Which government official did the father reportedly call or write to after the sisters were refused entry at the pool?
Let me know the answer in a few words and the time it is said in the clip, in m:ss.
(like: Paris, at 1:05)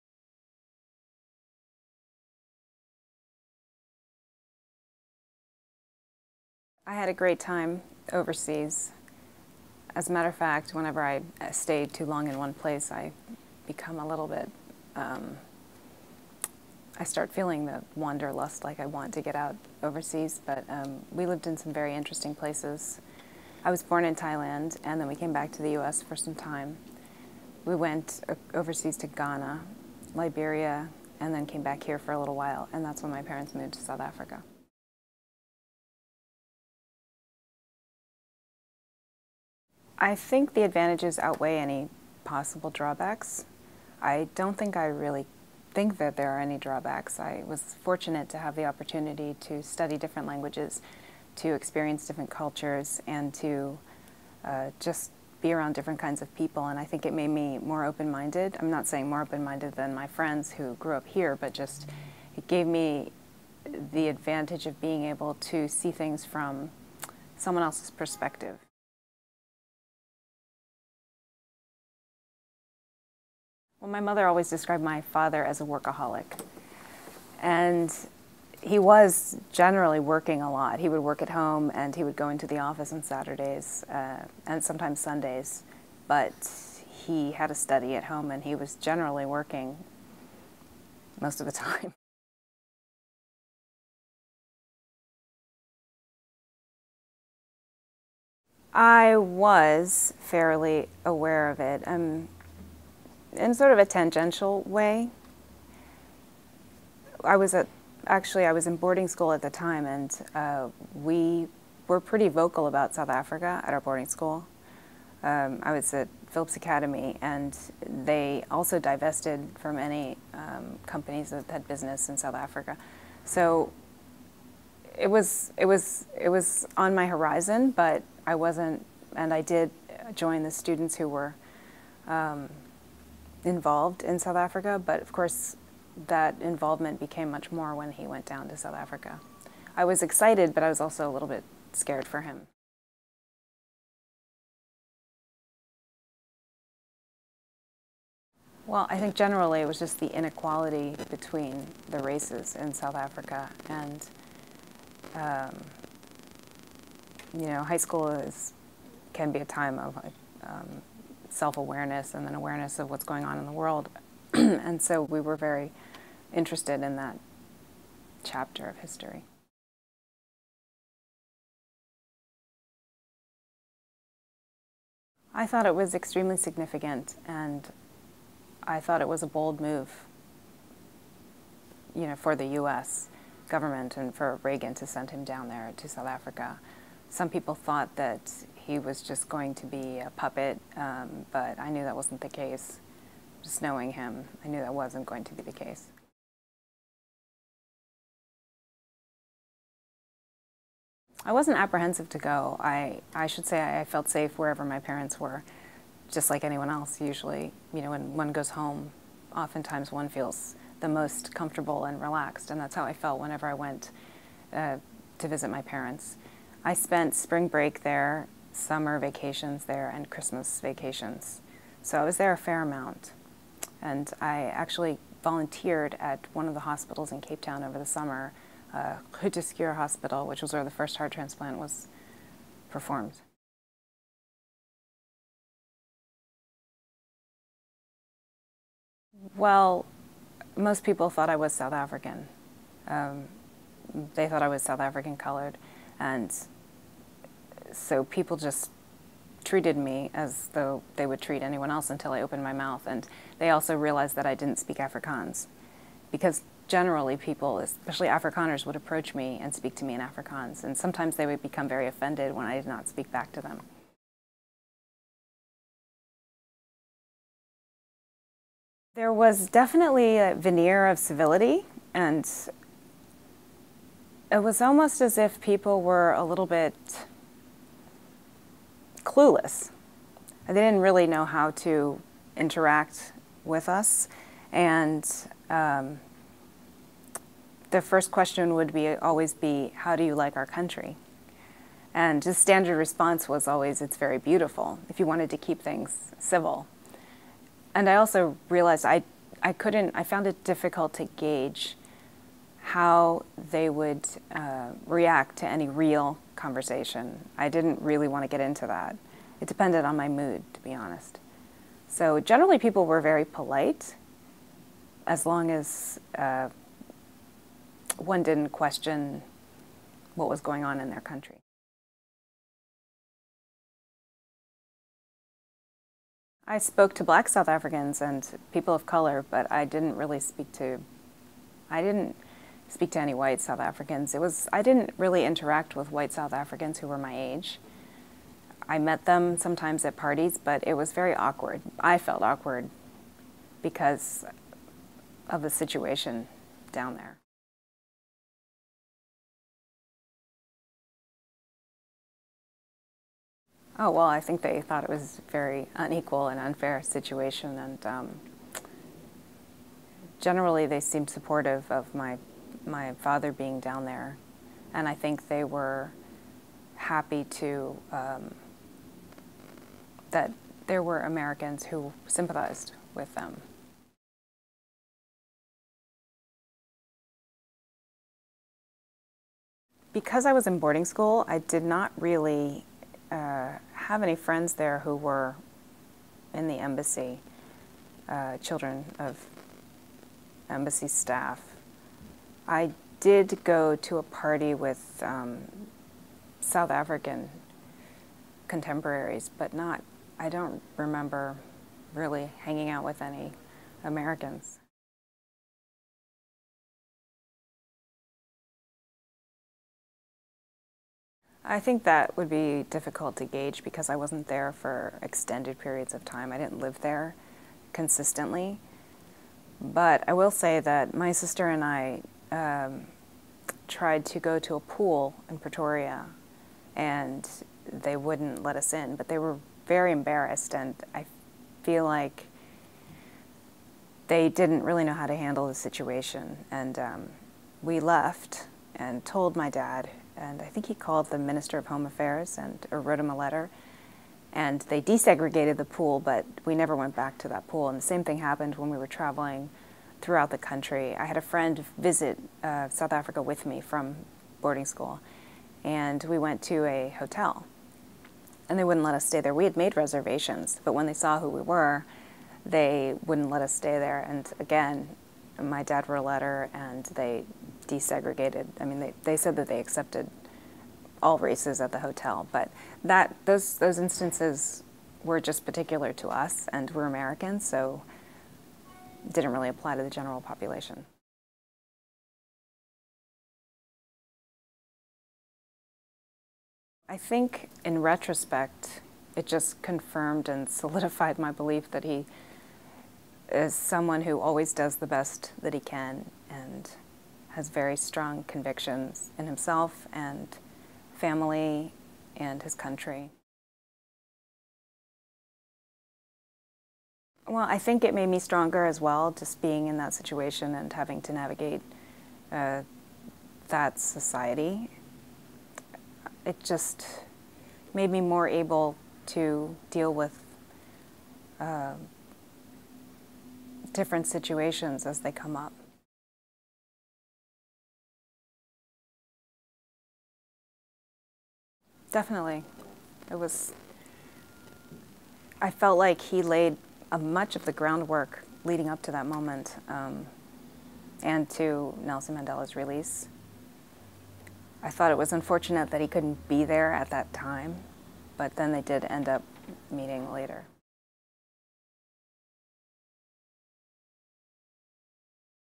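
Minister of Home Affairs, at 7:21.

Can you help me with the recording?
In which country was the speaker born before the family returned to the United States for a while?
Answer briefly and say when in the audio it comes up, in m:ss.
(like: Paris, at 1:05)
Thailand, at 0:24.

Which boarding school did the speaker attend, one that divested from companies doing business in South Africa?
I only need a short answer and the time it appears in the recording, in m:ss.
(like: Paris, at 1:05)
Phillips Academy, at 1:56.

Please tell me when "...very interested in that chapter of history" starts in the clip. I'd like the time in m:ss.
2:45.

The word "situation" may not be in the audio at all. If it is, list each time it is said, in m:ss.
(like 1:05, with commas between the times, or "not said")
5:45, 5:56, 7:15, 8:29, 8:44.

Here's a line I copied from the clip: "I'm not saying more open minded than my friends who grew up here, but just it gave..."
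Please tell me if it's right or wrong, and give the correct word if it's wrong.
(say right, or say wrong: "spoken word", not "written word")
right.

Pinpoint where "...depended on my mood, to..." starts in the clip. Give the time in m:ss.
5:09.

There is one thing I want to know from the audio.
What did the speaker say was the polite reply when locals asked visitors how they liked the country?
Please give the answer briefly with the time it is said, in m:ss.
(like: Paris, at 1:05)
It's very beautiful, at 4:53.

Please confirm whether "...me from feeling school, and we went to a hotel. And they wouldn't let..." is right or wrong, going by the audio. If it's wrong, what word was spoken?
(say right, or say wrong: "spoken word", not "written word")
wrong: "boarding", not "feeling".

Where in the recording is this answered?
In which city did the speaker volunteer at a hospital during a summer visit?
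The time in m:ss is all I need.
3:47.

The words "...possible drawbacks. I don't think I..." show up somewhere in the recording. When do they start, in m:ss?
0:42.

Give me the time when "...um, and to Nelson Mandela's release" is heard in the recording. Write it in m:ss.
8:59.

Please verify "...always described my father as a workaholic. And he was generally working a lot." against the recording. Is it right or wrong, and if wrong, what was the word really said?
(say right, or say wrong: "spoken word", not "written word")
right.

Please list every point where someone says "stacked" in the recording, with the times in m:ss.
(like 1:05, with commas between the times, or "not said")
not said.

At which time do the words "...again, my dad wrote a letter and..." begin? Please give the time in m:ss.
7:44.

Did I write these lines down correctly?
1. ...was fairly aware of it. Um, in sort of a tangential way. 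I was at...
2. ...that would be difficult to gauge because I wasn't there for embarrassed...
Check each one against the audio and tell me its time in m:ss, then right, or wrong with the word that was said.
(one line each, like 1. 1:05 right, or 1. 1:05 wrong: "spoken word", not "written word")
1. 1:39 right
2. 6:51 wrong: "extended", not "embarrassed".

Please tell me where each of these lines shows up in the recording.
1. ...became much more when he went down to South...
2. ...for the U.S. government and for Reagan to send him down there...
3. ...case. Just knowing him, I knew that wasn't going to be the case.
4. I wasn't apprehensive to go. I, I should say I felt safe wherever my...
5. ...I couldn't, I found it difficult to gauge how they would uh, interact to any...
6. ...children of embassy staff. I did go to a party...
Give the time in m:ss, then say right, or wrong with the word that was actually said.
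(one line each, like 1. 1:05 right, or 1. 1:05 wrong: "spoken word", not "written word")
1. 2:16 right
2. 3:02 right
3. 3:12 right
4. 3:21 right
5. 4:59 wrong: "react", not "interact"
6. 6:28 right.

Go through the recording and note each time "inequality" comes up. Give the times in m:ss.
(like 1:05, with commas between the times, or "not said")
2:30.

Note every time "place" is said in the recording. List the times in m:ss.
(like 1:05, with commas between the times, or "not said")
0:12, 0:22.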